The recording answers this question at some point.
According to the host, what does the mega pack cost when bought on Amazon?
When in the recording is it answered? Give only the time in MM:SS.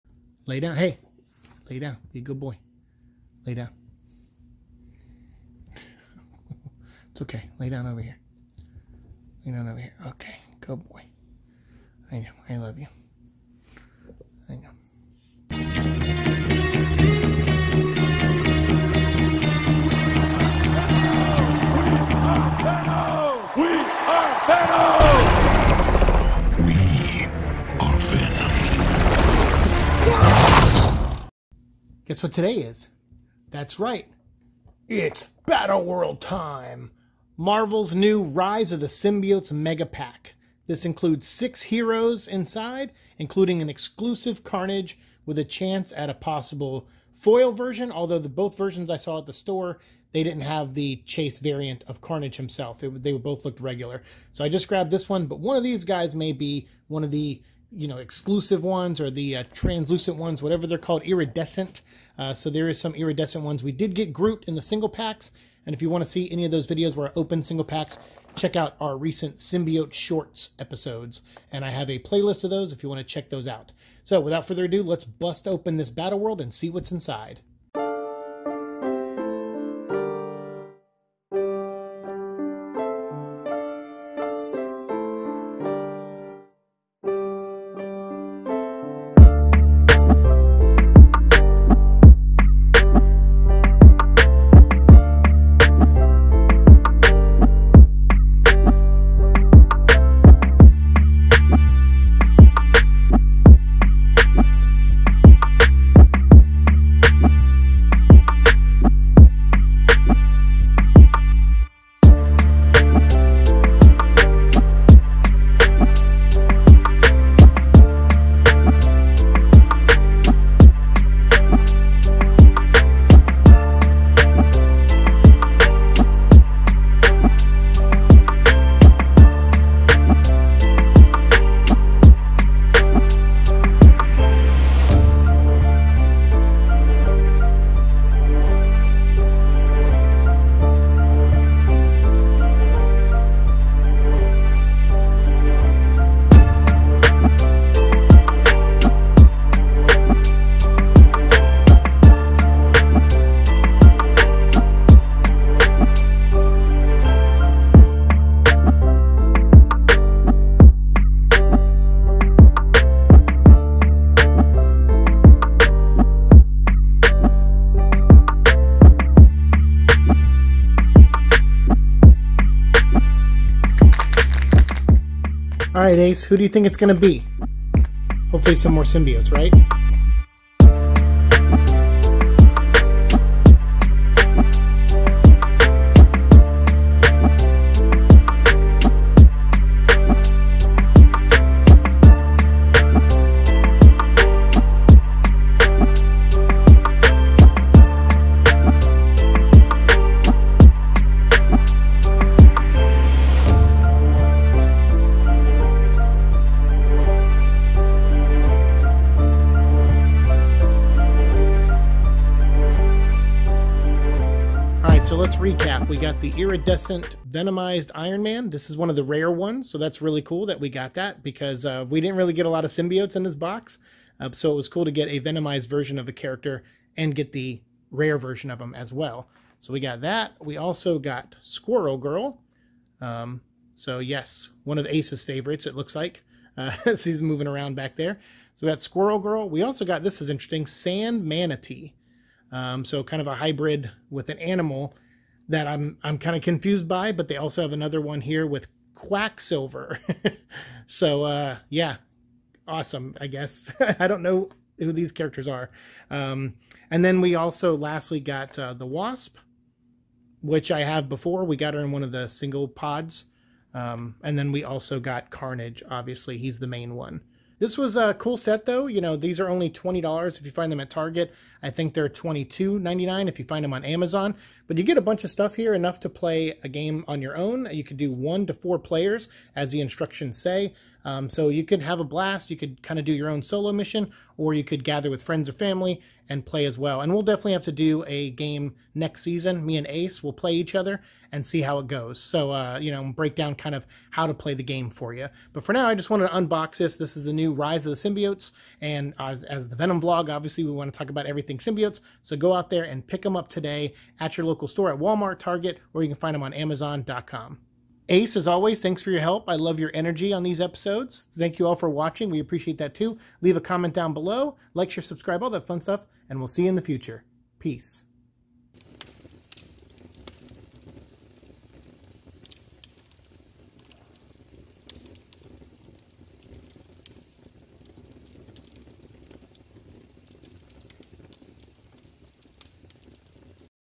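04:32.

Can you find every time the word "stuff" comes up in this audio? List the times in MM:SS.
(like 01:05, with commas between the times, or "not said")
04:35, 05:15.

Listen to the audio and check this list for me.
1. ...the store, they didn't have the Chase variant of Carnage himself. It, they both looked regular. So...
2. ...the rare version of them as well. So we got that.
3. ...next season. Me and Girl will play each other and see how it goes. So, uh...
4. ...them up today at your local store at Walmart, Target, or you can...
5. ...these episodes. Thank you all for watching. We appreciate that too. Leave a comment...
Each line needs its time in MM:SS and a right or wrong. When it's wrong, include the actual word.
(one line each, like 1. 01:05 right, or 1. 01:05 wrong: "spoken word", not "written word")
1. 00:49 right
2. 03:47 right
3. 04:48 wrong: "Ace", not "Girl"
4. 05:03 right
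5. 05:10 right.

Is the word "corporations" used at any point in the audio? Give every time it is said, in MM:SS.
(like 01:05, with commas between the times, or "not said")
not said.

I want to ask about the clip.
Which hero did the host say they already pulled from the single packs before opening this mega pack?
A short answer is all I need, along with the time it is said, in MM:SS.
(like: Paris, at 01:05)
Groot, at 01:04.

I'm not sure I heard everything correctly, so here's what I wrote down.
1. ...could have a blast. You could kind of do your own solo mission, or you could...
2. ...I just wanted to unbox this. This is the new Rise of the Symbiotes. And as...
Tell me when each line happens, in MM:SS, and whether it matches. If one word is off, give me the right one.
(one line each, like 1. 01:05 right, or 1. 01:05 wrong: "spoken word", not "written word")
1. 04:41 right
2. 04:55 right.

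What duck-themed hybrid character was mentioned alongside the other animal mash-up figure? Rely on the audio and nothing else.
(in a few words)
Quacksilver.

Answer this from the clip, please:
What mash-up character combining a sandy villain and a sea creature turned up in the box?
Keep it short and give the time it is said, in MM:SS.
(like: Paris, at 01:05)
Sand Manatee, at 04:00.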